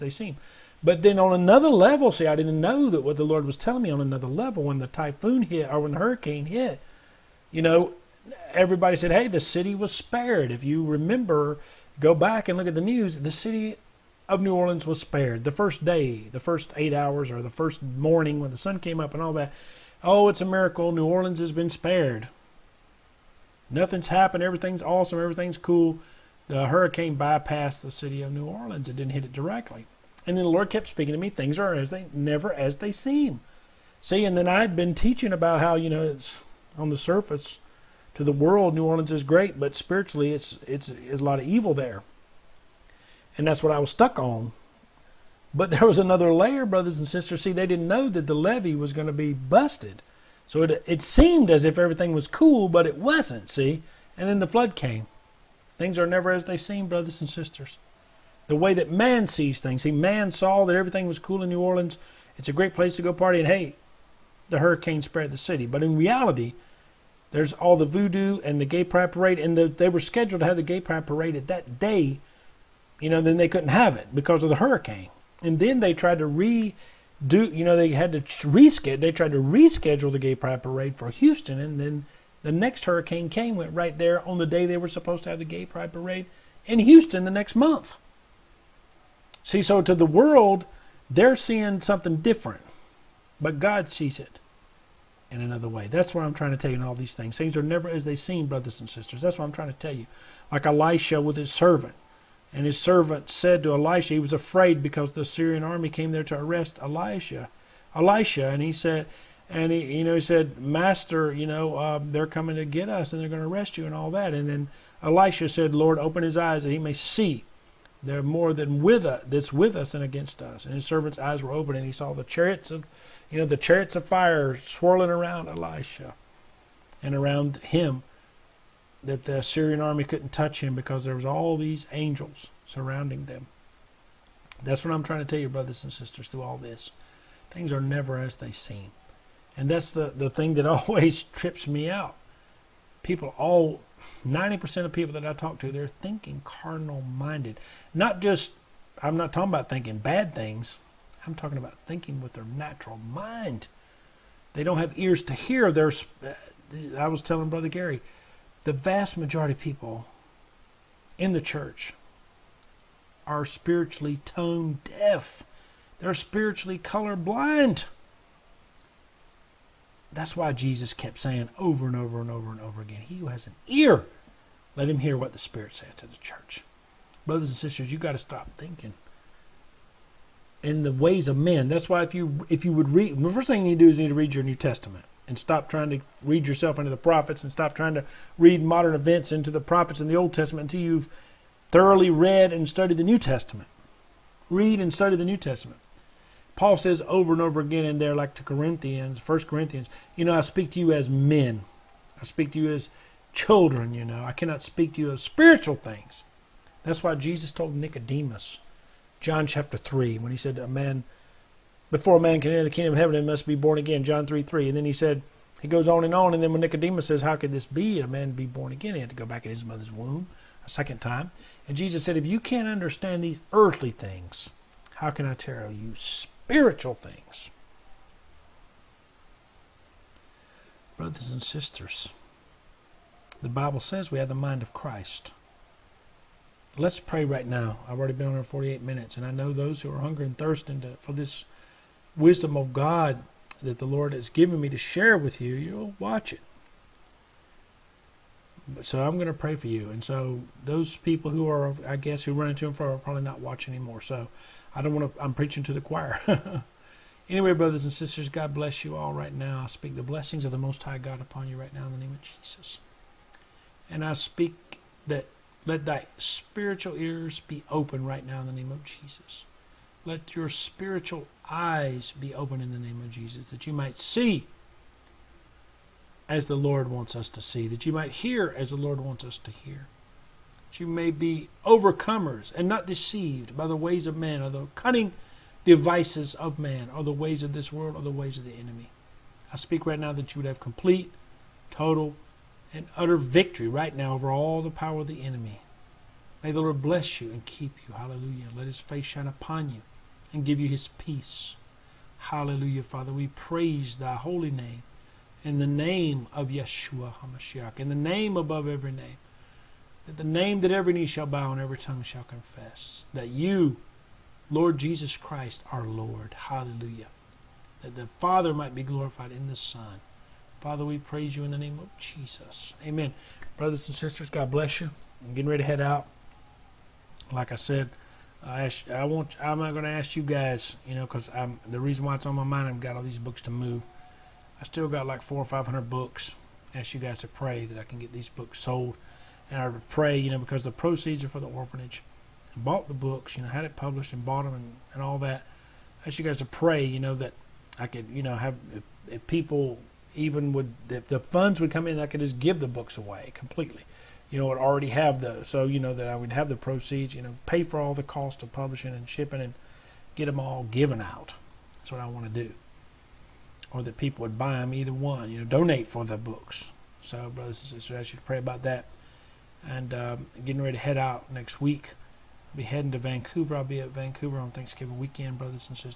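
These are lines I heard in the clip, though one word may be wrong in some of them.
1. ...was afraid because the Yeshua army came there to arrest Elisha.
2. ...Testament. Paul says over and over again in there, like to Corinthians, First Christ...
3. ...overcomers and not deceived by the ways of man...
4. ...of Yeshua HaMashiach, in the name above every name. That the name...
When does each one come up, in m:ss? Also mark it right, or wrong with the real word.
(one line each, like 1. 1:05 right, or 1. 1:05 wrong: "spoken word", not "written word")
1. 1:44 wrong: "Syrian", not "Yeshua"
2. 3:15 wrong: "Corinthians", not "Christ"
3. 4:41 right
4. 5:06 right.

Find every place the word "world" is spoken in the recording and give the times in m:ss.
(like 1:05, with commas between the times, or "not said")
0:38, 1:30, 4:47.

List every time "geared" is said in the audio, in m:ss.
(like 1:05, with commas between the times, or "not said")
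not said.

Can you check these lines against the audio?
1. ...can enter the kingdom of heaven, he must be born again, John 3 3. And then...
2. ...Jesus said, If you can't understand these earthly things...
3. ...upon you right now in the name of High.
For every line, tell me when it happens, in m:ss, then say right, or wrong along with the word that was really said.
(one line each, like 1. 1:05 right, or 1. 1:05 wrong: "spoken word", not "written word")
1. 3:32 right
2. 3:41 right
3. 4:21 wrong: "Jesus", not "High".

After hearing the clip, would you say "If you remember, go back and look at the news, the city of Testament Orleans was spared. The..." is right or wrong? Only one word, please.
wrong.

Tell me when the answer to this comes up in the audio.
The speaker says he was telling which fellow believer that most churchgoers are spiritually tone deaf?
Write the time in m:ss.
2:37.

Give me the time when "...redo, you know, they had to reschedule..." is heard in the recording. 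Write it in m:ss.
1:16.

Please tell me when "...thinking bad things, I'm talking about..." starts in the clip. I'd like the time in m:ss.
2:29.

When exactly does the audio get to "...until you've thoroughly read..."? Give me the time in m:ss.
3:10.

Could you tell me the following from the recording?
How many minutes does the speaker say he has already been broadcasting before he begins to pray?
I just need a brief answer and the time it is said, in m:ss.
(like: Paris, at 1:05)
48, at 3:58.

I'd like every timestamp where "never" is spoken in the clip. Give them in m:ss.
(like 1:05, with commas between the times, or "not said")
0:32, 0:56, 1:37, 2:17.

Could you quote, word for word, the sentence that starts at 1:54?
And then Elisha said, Lord, open his eyes that he may see.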